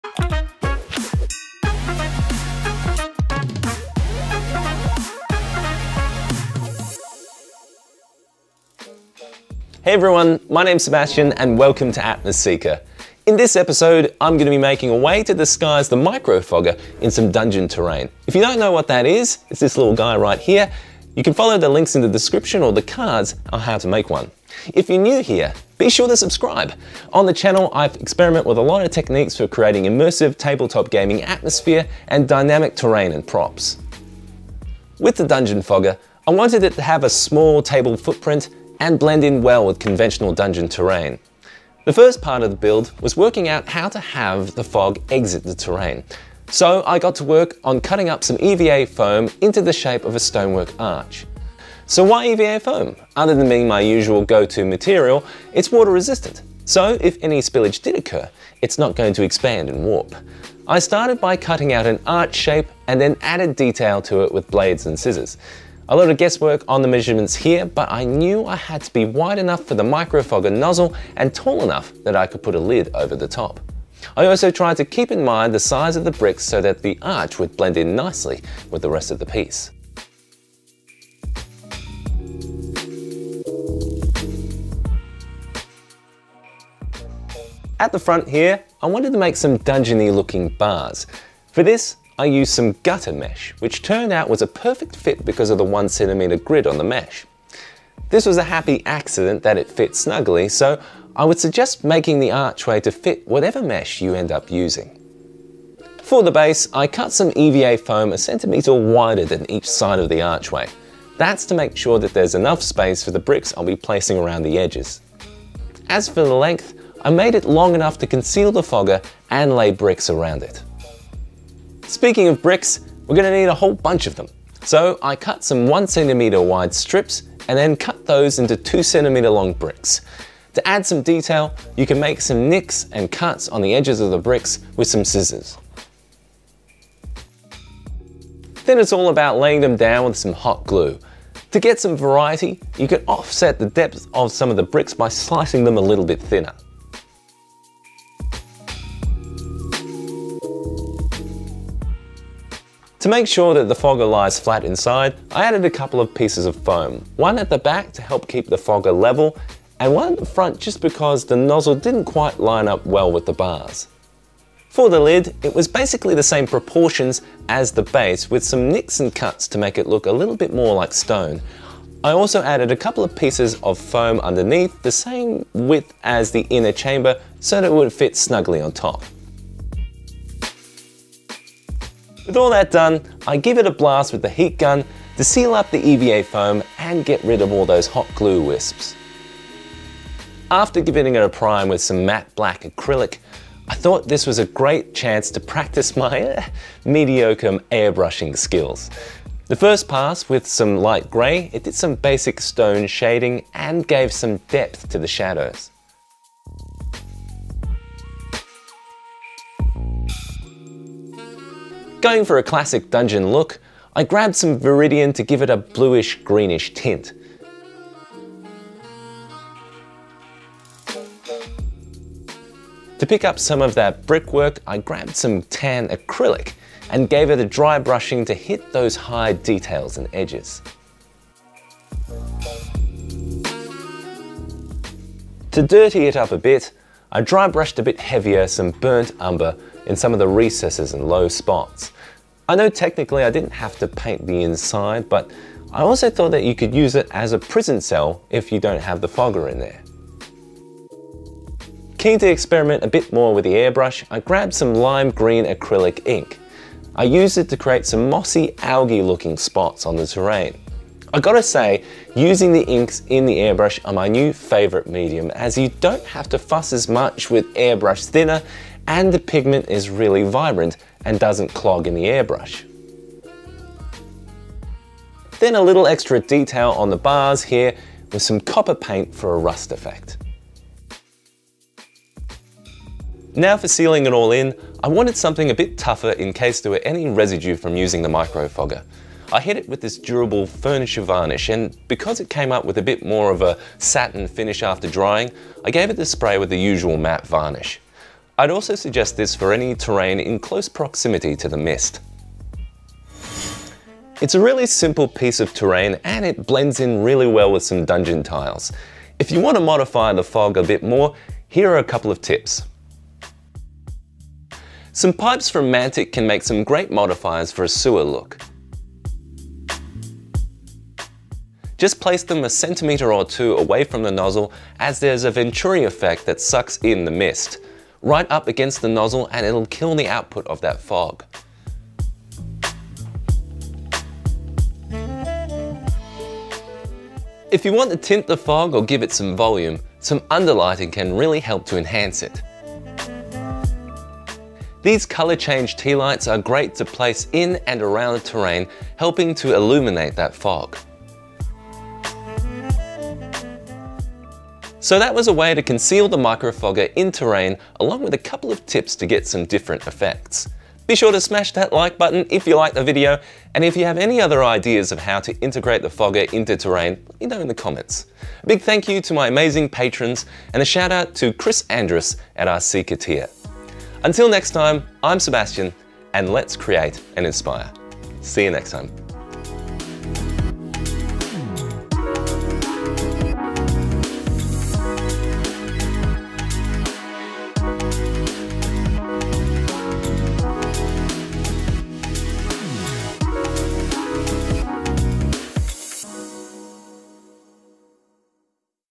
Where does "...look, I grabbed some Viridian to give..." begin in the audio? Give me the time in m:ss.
3:33.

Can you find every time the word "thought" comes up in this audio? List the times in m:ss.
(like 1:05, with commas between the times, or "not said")
3:13, 4:06.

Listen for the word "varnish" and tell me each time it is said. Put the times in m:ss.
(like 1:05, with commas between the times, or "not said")
4:51, 4:57.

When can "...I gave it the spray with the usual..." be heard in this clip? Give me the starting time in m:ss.
4:55.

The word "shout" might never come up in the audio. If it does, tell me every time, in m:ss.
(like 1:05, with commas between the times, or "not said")
6:10.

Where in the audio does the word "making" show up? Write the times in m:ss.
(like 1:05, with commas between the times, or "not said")
0:14, 1:41.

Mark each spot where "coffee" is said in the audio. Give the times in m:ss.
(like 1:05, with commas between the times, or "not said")
not said.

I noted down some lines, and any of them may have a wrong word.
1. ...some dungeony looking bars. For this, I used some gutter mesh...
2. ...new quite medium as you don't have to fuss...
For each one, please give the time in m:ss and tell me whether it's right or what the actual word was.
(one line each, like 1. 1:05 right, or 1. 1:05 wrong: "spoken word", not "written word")
1. 1:29 right
2. 4:24 wrong: "favorite", not "quite".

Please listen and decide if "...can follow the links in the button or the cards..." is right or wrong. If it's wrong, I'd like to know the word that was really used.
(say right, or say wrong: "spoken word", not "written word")
wrong: "description", not "button".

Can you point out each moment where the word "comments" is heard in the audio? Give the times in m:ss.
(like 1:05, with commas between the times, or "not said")
6:07.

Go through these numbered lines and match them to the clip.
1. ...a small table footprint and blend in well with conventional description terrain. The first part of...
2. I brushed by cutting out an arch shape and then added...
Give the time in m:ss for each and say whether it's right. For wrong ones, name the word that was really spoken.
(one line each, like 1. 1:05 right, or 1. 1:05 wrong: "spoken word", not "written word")
1. 0:37 wrong: "dungeon", not "description"
2. 1:00 wrong: "started", not "brushed".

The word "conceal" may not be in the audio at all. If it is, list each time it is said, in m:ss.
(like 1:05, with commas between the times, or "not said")
1:58, 5:55.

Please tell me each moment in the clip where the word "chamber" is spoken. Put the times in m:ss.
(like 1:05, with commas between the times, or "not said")
2:56.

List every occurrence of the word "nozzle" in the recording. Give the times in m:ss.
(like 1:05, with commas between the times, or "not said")
1:10, 2:41, 5:24, 5:28.